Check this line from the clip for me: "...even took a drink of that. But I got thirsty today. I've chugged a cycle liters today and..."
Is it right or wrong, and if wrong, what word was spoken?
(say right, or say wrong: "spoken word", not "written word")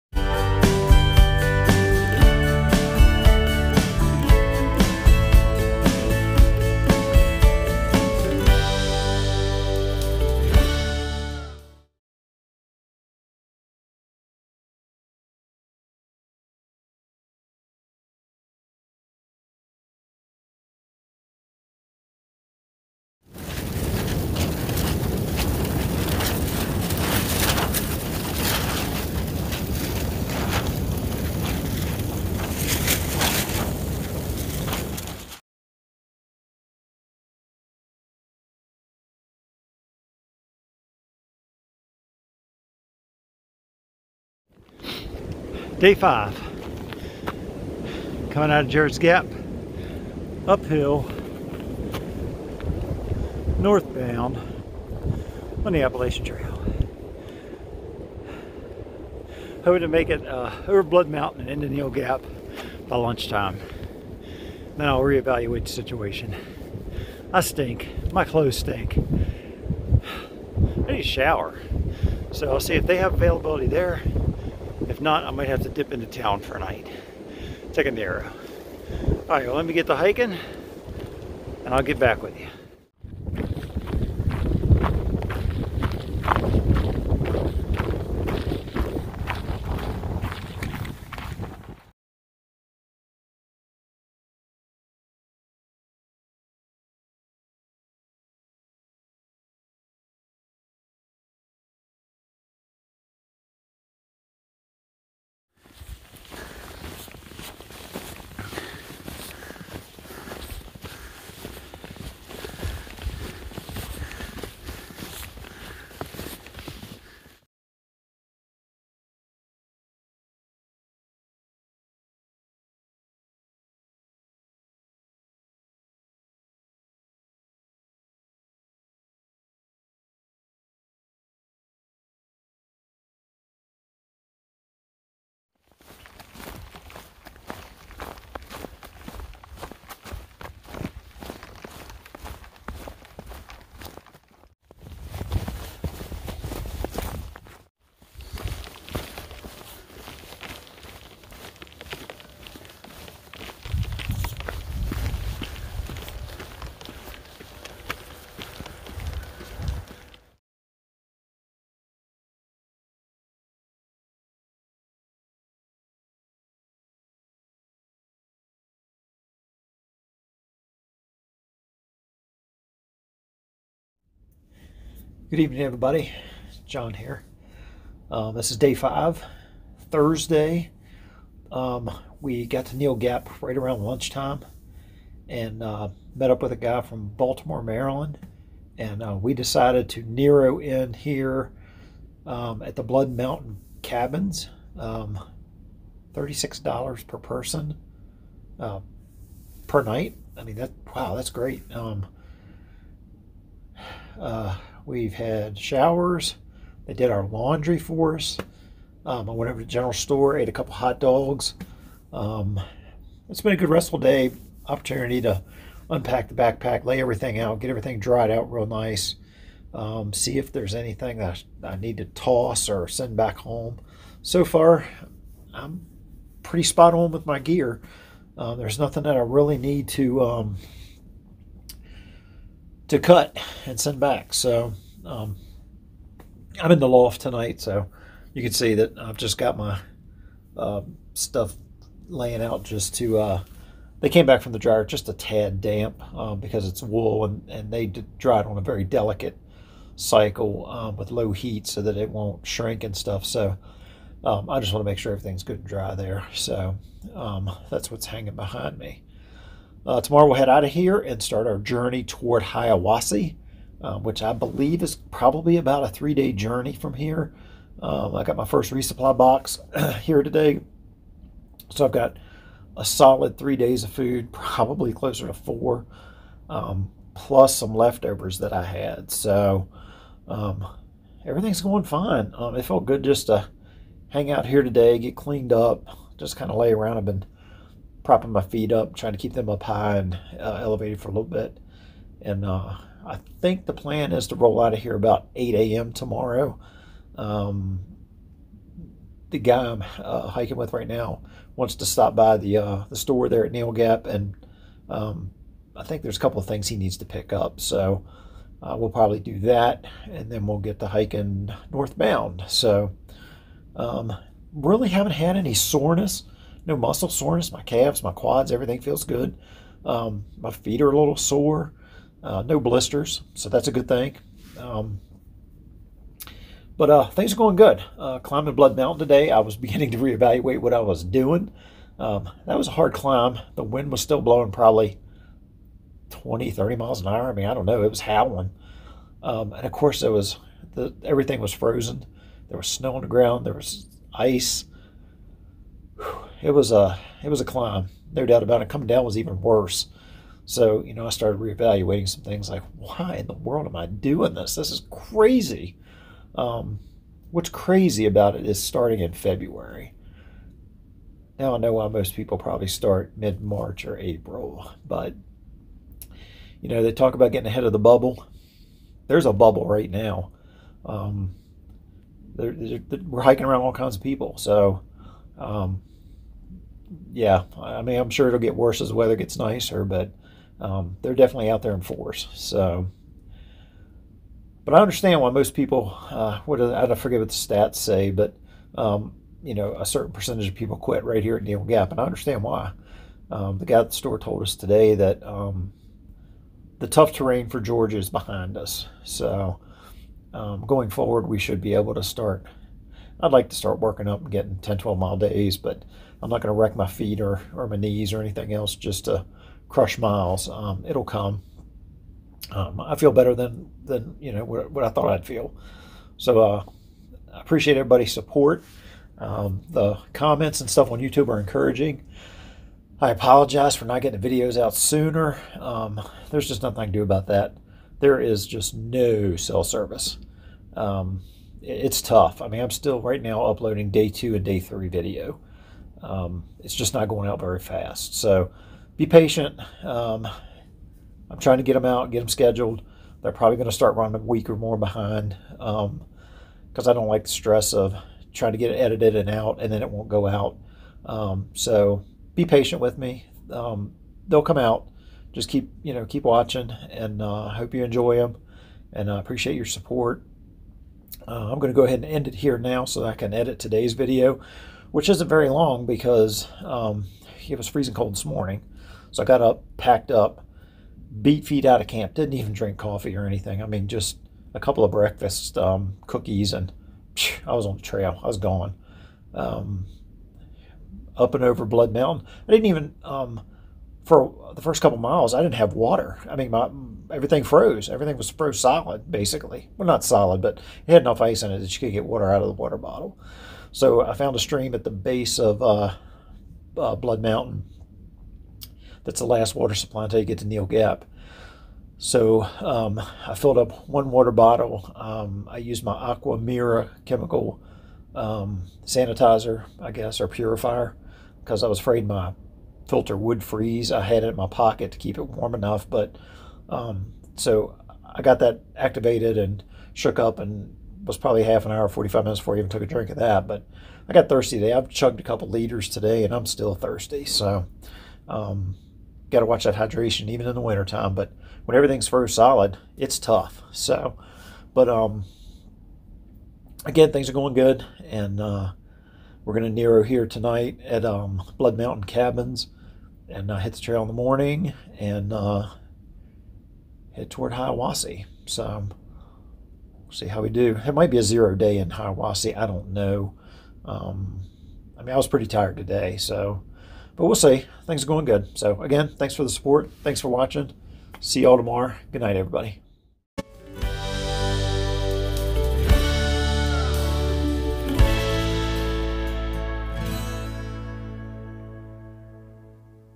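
wrong: "couple", not "cycle".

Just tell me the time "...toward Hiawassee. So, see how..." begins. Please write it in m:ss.
9:07.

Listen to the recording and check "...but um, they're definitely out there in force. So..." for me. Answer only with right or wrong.
right.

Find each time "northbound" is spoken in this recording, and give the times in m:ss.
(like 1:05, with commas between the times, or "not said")
0:53, 5:11.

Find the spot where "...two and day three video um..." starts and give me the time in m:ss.
7:14.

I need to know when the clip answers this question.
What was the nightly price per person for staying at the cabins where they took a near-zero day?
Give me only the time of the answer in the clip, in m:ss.
3:16.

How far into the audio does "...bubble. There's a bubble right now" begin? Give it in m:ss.
6:07.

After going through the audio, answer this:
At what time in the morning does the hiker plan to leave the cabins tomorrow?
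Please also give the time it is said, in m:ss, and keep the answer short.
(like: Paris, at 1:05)
8 a.m., at 4:55.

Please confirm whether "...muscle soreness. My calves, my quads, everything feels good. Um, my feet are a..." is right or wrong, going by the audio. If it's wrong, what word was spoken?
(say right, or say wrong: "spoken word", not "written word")
right.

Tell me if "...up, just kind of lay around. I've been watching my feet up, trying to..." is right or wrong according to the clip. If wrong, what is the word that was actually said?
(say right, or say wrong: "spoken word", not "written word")
wrong: "propping", not "watching".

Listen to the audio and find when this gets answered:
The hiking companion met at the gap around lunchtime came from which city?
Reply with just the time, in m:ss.
3:07.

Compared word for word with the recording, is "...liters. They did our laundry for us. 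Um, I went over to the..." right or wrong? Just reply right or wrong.
wrong.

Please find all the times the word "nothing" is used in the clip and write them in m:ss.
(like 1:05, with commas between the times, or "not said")
3:48, 7:06.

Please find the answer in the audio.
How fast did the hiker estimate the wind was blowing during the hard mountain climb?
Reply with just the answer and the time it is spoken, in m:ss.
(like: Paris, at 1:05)
20 to 30 mph, at 5:36.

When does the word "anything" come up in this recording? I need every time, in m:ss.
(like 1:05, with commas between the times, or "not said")
3:40, 6:48, 7:53.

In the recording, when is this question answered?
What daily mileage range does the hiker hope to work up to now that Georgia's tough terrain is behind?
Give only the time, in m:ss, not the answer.
6:44.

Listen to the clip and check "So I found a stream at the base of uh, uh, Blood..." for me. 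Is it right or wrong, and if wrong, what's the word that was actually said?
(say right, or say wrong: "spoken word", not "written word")
right.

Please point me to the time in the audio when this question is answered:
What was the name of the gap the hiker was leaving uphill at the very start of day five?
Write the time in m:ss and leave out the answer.
0:48.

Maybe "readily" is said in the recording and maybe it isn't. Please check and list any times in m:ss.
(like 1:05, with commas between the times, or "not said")
not said.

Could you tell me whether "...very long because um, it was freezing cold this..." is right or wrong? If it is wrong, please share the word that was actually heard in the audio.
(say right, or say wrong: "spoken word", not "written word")
right.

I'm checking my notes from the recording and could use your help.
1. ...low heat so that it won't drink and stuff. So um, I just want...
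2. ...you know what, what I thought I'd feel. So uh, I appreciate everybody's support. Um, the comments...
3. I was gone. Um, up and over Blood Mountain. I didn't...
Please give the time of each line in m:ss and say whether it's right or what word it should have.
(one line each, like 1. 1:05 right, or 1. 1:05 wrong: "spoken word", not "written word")
1. 4:11 wrong: "shrink", not "drink"
2. 6:54 right
3. 7:58 right.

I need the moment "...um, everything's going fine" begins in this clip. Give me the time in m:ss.
4:40.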